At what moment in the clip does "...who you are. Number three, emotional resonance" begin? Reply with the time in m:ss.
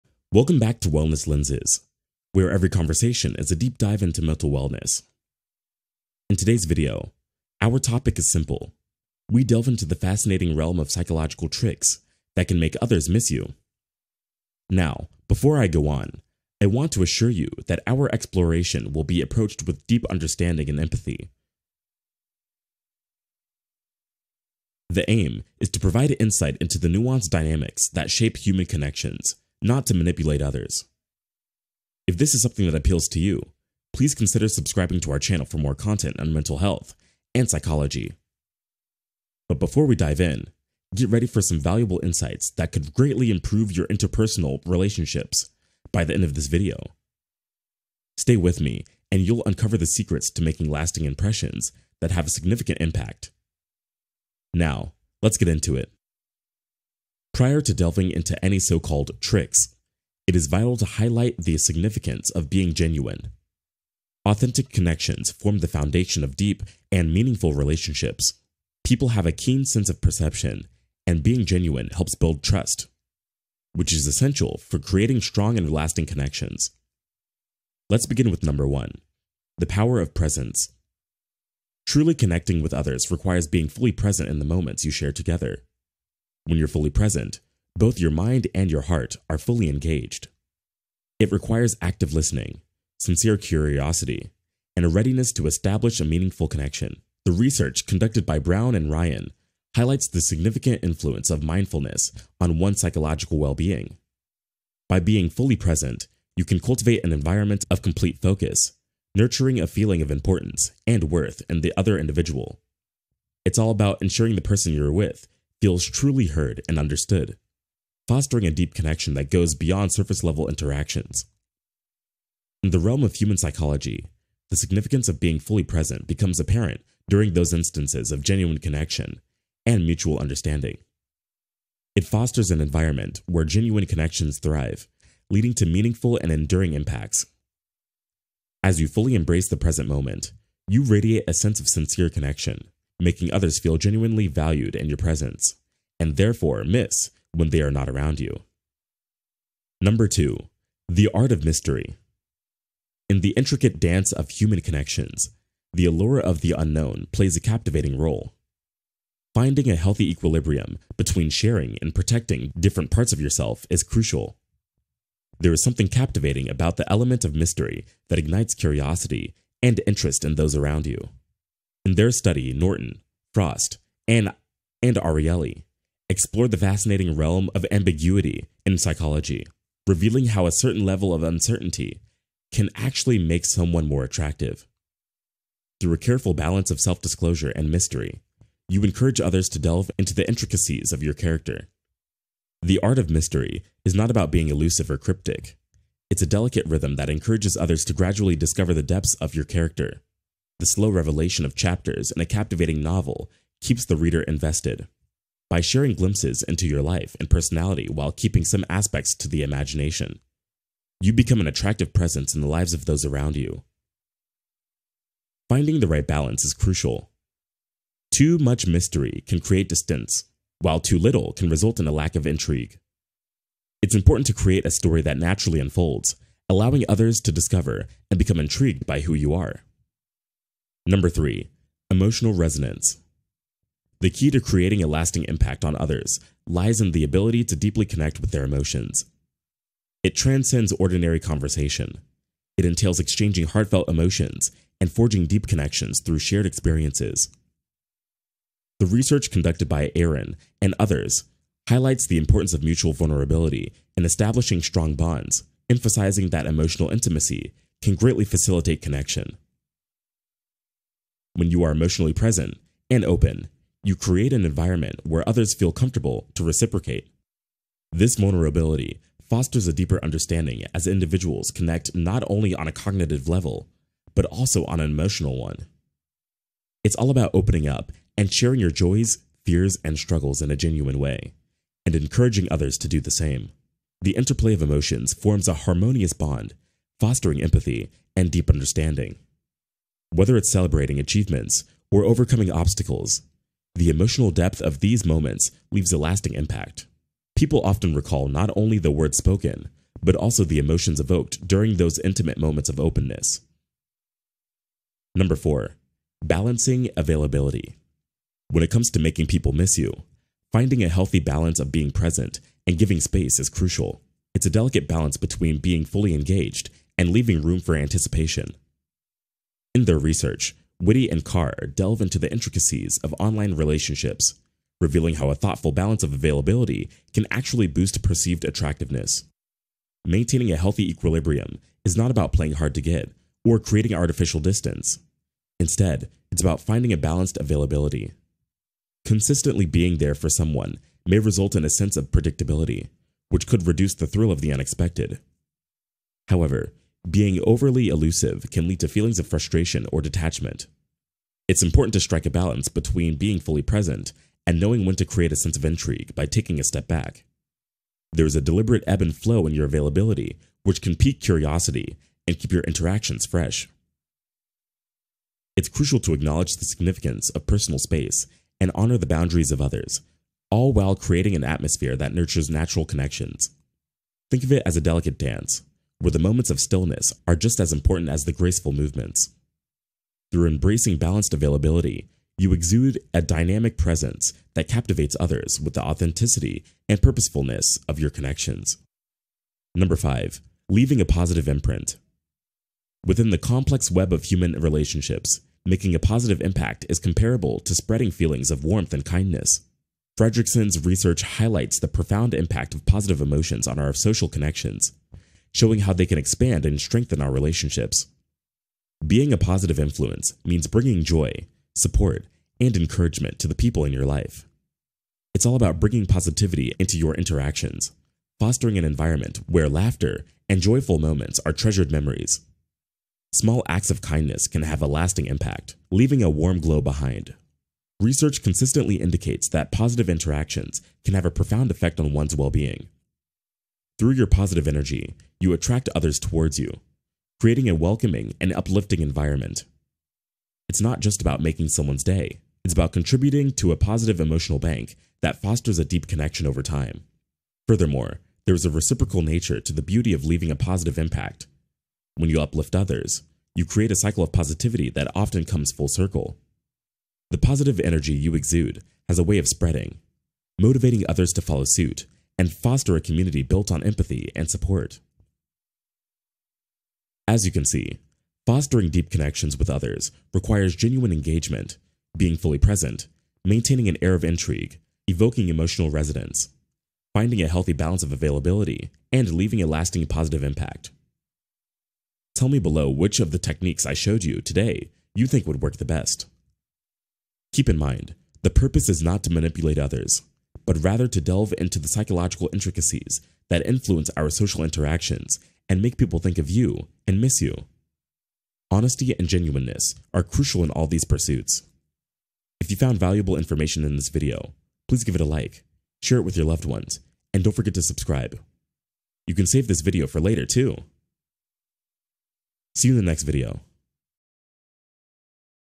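3:48.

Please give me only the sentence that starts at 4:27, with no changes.
This vulnerability fosters a deeper understanding as individuals connect not only on a cognitive level, but also on an emotional one.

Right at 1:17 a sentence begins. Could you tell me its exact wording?
Let's begin with number one, the power of presence.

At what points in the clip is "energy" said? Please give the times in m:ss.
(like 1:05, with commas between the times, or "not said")
7:14, 7:37.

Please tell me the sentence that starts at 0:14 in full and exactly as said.
Now, before I go on, I want to assure you that our exploration will be approached with deep understanding and empathy.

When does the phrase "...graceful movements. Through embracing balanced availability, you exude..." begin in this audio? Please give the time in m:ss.
6:18.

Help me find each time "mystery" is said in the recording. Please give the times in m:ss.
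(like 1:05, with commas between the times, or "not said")
2:31, 2:47, 3:07, 3:13, 3:38.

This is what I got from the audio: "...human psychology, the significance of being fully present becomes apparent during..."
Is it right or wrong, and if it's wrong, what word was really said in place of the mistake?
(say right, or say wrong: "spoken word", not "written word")
right.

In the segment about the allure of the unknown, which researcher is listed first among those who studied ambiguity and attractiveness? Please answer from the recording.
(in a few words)
Norton.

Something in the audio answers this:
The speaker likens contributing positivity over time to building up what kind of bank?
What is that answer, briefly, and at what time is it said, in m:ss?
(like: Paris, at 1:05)
Positive emotional bank, at 7:23.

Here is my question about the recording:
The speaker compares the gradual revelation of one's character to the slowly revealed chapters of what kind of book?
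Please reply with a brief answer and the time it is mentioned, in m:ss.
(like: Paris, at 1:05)
A captivating novel, at 3:22.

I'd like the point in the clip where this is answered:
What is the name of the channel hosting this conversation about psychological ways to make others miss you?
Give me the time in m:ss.
0:00.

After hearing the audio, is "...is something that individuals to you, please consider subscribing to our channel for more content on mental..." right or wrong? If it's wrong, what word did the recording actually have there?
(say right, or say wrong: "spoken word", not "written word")
wrong: "appeals", not "individuals".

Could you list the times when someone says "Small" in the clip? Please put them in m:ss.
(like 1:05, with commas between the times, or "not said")
7:03.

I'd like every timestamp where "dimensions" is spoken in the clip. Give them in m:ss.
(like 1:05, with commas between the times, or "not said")
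not said.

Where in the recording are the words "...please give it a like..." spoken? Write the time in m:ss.
8:24.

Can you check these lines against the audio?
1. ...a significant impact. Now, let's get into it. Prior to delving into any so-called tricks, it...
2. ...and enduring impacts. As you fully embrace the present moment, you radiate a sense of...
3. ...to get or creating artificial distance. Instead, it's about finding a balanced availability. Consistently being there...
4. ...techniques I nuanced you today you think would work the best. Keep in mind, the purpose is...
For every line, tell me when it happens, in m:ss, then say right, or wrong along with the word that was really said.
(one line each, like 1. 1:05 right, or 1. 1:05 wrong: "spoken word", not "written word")
1. 0:52 right
2. 2:16 right
3. 5:32 right
4. 8:03 wrong: "showed", not "nuanced".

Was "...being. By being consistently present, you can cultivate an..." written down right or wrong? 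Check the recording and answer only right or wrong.
wrong.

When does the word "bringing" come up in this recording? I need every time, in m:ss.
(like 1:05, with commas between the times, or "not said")
6:50, 6:55.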